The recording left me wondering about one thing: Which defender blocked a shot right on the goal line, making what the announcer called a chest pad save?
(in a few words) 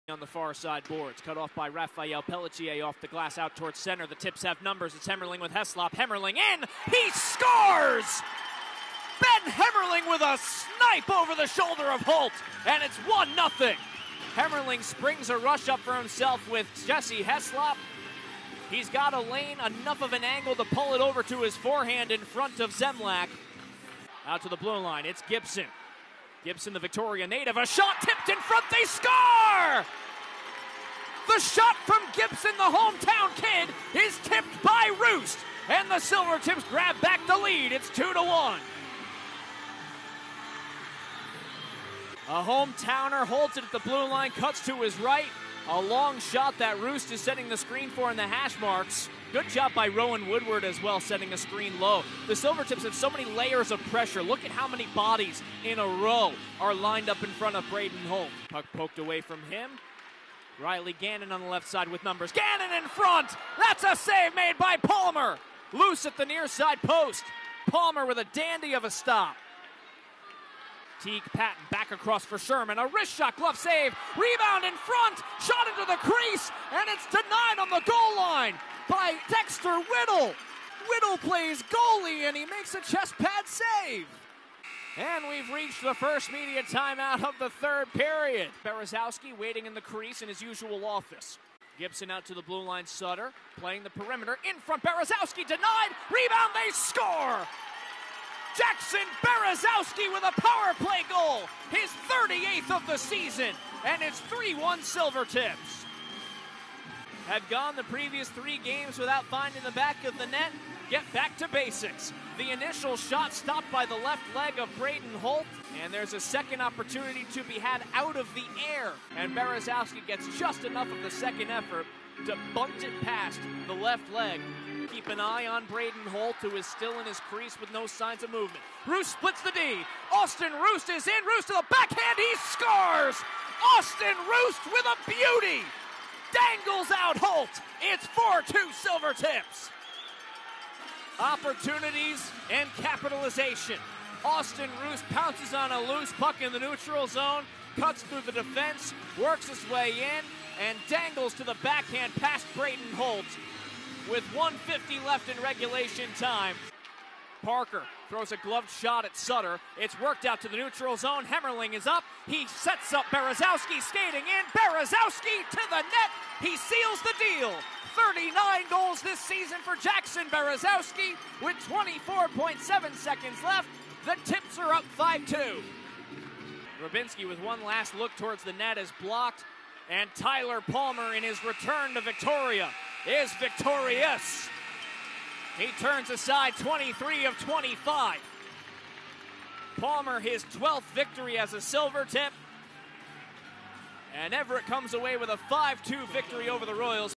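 Dexter Whittle.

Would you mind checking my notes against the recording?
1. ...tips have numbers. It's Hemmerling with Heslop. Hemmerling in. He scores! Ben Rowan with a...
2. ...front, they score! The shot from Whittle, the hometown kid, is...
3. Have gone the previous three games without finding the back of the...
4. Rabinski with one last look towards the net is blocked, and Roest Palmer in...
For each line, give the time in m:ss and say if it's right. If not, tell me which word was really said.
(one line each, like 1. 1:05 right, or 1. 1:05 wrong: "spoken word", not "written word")
1. 0:04 wrong: "Hemmerling", not "Rowan"
2. 0:28 wrong: "Gibson", not "Whittle"
3. 1:47 right
4. 2:56 wrong: "Tyler", not "Roest".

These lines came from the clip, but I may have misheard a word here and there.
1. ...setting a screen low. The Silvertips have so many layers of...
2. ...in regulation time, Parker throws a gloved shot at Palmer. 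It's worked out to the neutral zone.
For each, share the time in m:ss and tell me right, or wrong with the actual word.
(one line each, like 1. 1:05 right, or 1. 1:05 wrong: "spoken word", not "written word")
1. 0:50 right
2. 2:35 wrong: "Sutter", not "Palmer".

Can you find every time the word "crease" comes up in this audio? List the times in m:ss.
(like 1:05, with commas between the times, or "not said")
1:15, 1:29, 2:07.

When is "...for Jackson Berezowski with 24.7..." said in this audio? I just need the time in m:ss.
2:49.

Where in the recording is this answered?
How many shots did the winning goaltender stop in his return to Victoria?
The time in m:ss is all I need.
3:06.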